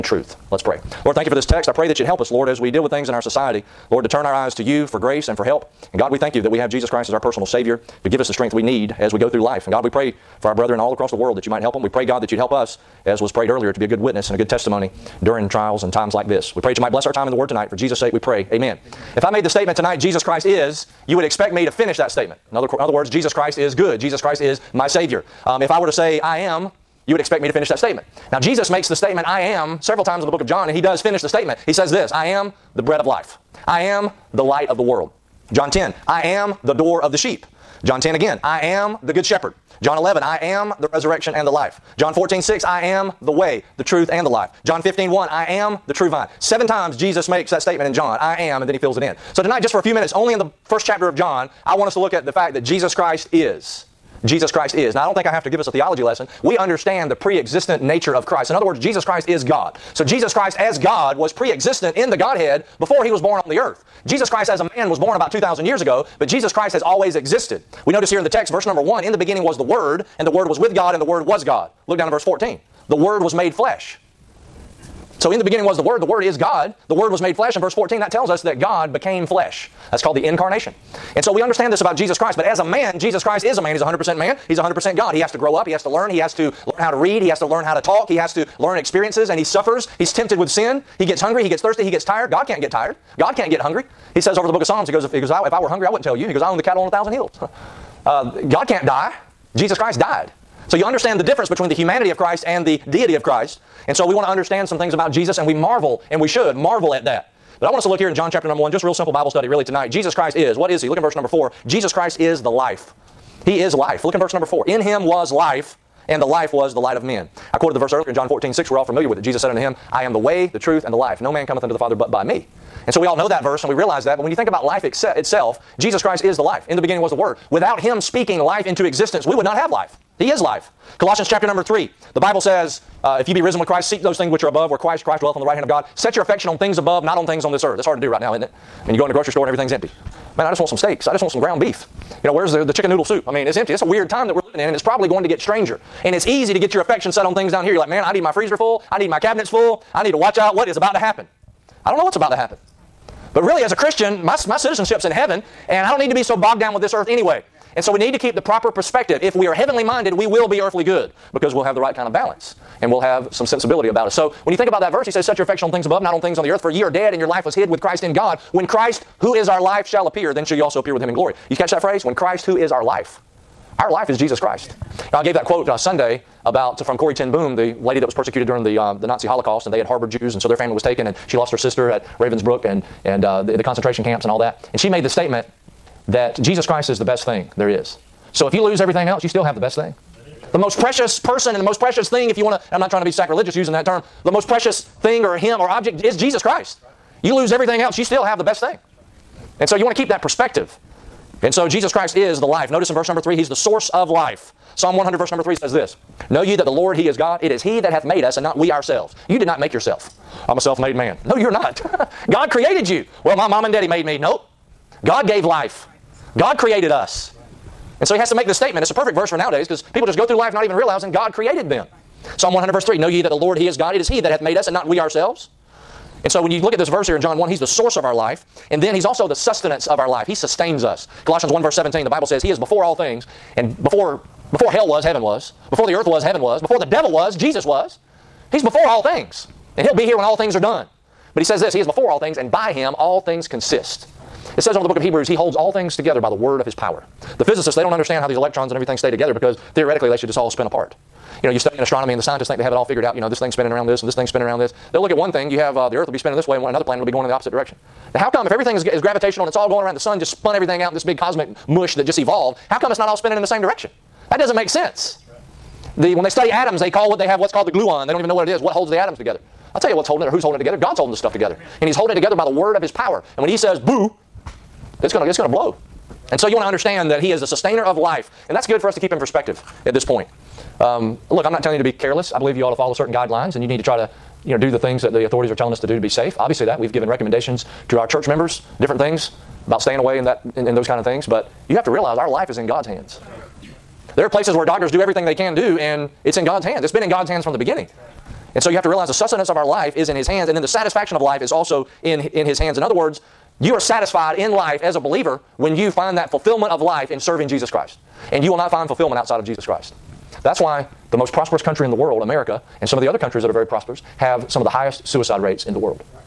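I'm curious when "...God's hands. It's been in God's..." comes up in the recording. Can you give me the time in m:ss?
4:56.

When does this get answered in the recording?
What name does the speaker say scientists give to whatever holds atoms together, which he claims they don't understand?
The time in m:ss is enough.
4:27.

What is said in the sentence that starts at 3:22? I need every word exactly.
Notice in verse number three, He's the source of life.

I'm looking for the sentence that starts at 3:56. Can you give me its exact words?
Before the devil was, Jesus was.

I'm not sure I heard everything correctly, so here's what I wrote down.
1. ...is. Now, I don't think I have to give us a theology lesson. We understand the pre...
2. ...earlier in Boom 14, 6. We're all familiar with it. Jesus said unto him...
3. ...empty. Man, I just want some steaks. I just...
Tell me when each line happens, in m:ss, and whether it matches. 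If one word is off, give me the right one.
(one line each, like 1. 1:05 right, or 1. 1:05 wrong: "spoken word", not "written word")
1. 0:54 right
2. 1:57 wrong: "John", not "Boom"
3. 2:19 right.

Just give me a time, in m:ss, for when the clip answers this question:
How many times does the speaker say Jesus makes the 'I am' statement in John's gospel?
0:46.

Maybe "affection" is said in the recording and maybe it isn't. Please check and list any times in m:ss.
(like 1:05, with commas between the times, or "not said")
2:16, 2:26, 2:45.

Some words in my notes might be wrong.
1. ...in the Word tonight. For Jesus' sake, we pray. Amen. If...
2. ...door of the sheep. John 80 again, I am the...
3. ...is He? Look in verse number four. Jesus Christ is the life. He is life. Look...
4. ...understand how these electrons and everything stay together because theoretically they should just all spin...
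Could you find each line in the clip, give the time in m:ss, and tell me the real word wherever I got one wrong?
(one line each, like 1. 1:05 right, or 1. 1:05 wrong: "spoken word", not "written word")
1. 0:17 right
2. 0:36 wrong: "10", not "80"
3. 1:50 right
4. 4:07 right.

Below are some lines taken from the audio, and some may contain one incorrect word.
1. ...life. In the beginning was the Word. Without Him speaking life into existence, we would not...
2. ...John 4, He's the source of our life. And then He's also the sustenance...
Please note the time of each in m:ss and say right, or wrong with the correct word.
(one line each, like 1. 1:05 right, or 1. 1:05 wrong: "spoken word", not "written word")
1. 2:06 right
2. 3:47 wrong: "1", not "4".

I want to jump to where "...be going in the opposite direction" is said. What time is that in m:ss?
4:17.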